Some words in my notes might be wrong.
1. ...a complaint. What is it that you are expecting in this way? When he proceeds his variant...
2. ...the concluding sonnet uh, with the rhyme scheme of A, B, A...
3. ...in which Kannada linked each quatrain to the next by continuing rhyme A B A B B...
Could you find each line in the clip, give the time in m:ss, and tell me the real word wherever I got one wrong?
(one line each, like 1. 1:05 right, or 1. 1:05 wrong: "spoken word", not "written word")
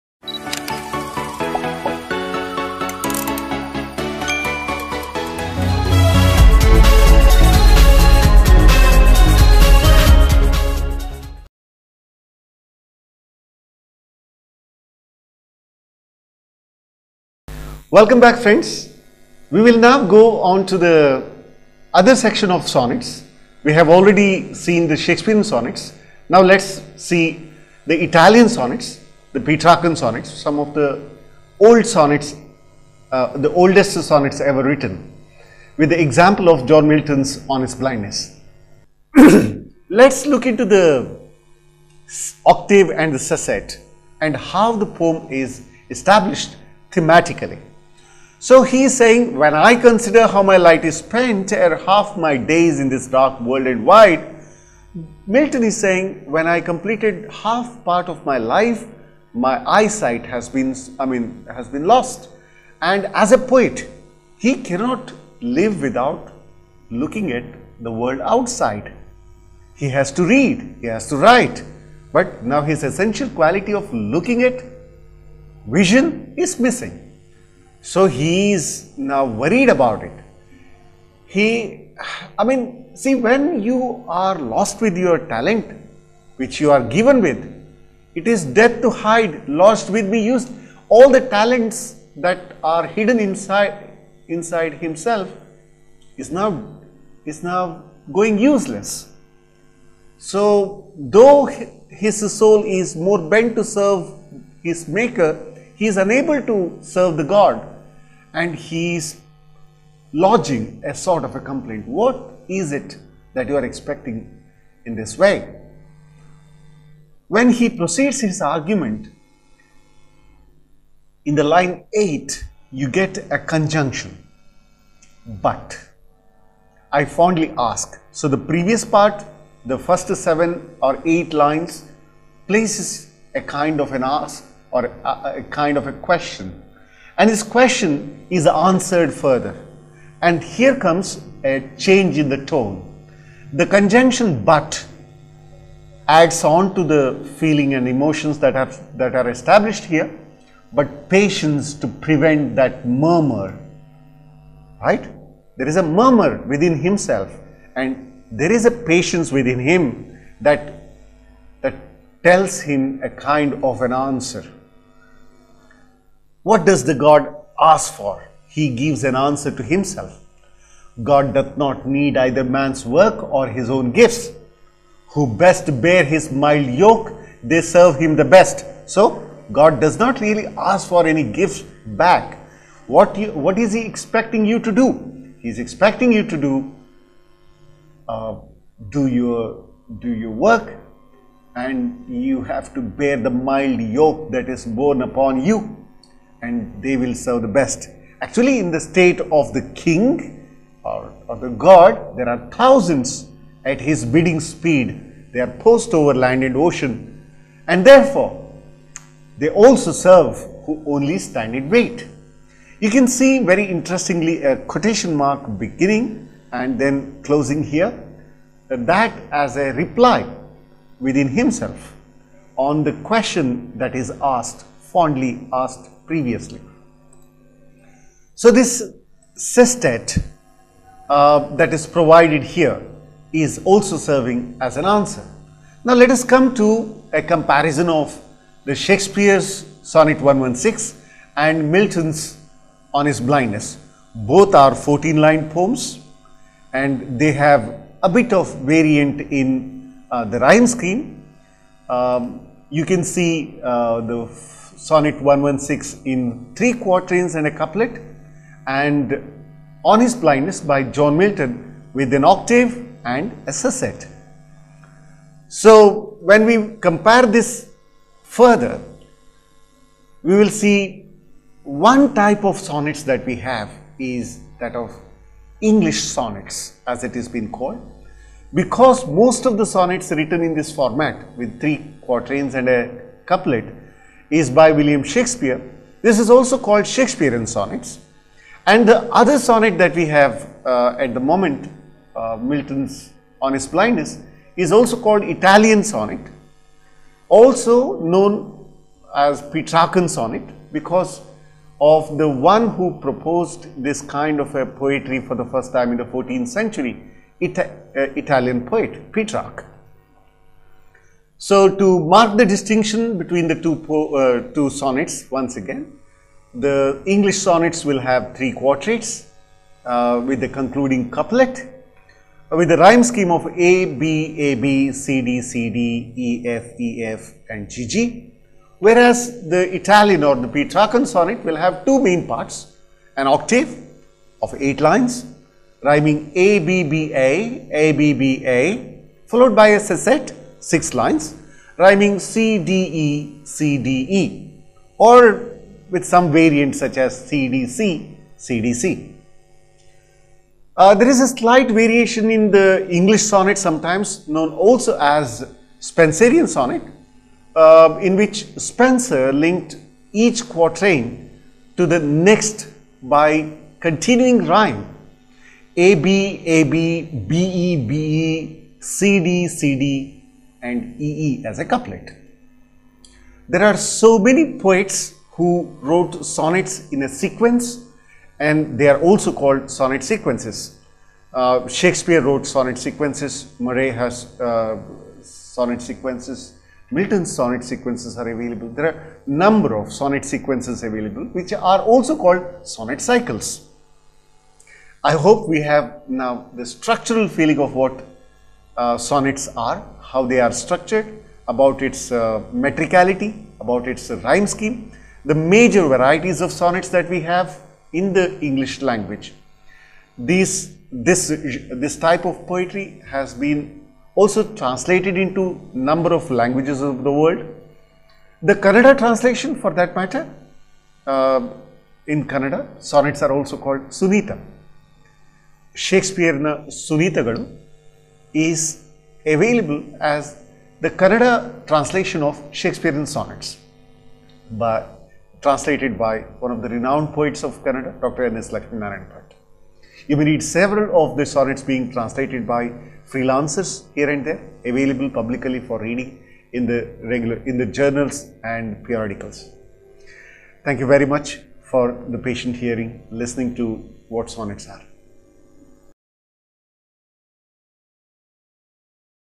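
1. 1:51 wrong: "argument", not "variant"
2. 5:20 wrong: "couplet", not "sonnet"
3. 5:58 wrong: "Spenser", not "Kannada".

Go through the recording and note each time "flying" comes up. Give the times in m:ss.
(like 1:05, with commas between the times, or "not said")
not said.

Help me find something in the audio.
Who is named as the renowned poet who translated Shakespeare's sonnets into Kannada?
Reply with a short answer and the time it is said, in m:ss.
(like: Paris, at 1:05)
Dr. N. S. Lakshmi Narayan Bhatt, at 7:17.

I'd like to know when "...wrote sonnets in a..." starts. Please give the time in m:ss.
6:15.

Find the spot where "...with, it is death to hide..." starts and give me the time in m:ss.
1:27.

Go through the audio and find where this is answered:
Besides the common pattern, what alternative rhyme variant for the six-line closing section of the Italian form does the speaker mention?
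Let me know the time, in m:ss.
5:47.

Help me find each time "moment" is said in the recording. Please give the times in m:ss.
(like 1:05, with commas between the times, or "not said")
4:51.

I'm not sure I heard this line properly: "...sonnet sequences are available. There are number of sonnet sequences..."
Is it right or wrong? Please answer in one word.
right.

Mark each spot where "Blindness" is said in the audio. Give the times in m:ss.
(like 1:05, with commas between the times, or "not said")
0:37, 4:03, 4:20, 4:53.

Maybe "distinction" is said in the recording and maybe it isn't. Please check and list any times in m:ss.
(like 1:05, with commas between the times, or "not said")
5:12.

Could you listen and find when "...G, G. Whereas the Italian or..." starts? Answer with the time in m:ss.
5:27.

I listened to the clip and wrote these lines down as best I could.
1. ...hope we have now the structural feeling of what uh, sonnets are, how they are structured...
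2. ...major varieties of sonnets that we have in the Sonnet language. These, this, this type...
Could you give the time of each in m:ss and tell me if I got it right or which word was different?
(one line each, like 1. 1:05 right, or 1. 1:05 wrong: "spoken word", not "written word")
1. 6:35 right
2. 6:45 wrong: "English", not "Sonnet".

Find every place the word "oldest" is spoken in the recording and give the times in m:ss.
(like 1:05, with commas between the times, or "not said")
0:33.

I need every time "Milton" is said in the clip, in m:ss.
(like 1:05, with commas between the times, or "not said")
0:36, 0:55, 4:01, 4:21, 4:52, 6:26.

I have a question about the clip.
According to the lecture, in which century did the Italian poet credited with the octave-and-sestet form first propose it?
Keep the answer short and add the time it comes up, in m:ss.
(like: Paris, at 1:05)
14th century, at 5:06.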